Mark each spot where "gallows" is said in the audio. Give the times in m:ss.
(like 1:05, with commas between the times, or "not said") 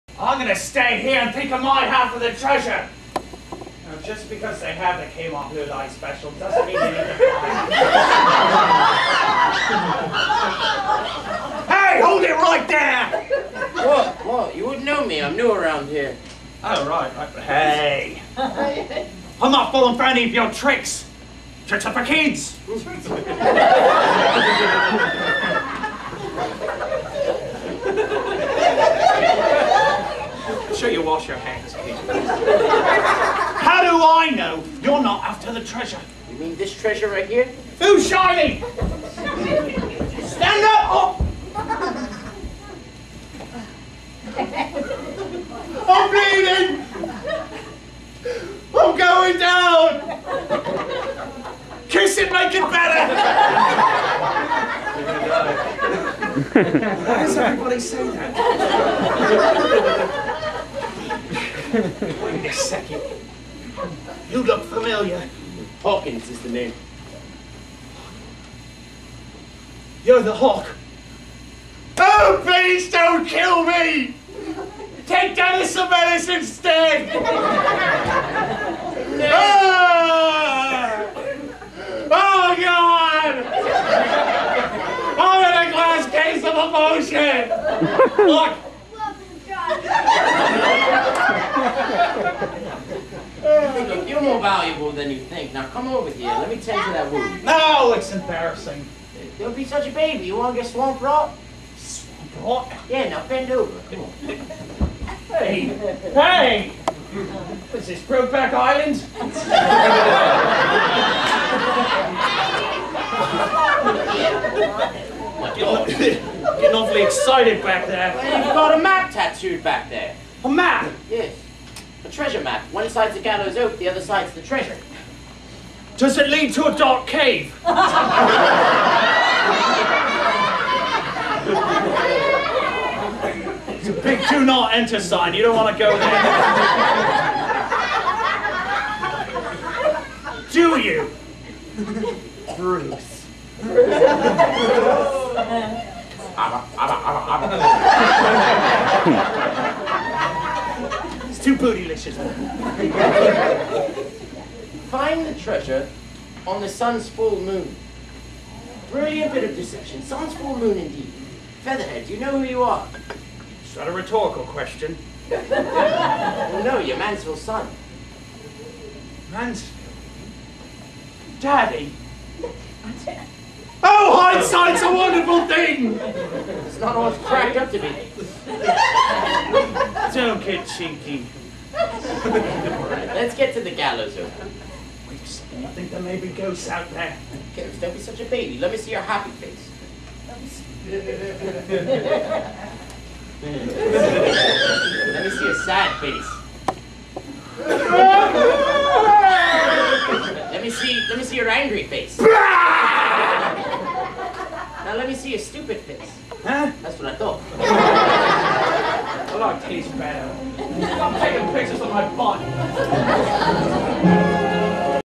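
2:03, 3:03.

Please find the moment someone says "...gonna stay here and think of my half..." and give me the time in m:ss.
0:00.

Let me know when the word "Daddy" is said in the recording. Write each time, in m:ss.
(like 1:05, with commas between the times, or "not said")
2:51.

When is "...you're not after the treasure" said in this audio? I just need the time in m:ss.
0:34.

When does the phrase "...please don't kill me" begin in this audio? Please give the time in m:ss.
1:12.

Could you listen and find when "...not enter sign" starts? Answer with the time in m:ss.
2:14.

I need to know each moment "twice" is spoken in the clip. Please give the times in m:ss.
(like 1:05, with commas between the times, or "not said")
not said.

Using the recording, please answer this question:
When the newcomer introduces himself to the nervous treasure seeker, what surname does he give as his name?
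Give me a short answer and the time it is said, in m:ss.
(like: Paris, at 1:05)
Hawkins, at 1:05.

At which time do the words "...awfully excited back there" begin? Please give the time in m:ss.
1:56.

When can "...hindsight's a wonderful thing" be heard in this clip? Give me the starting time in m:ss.
2:54.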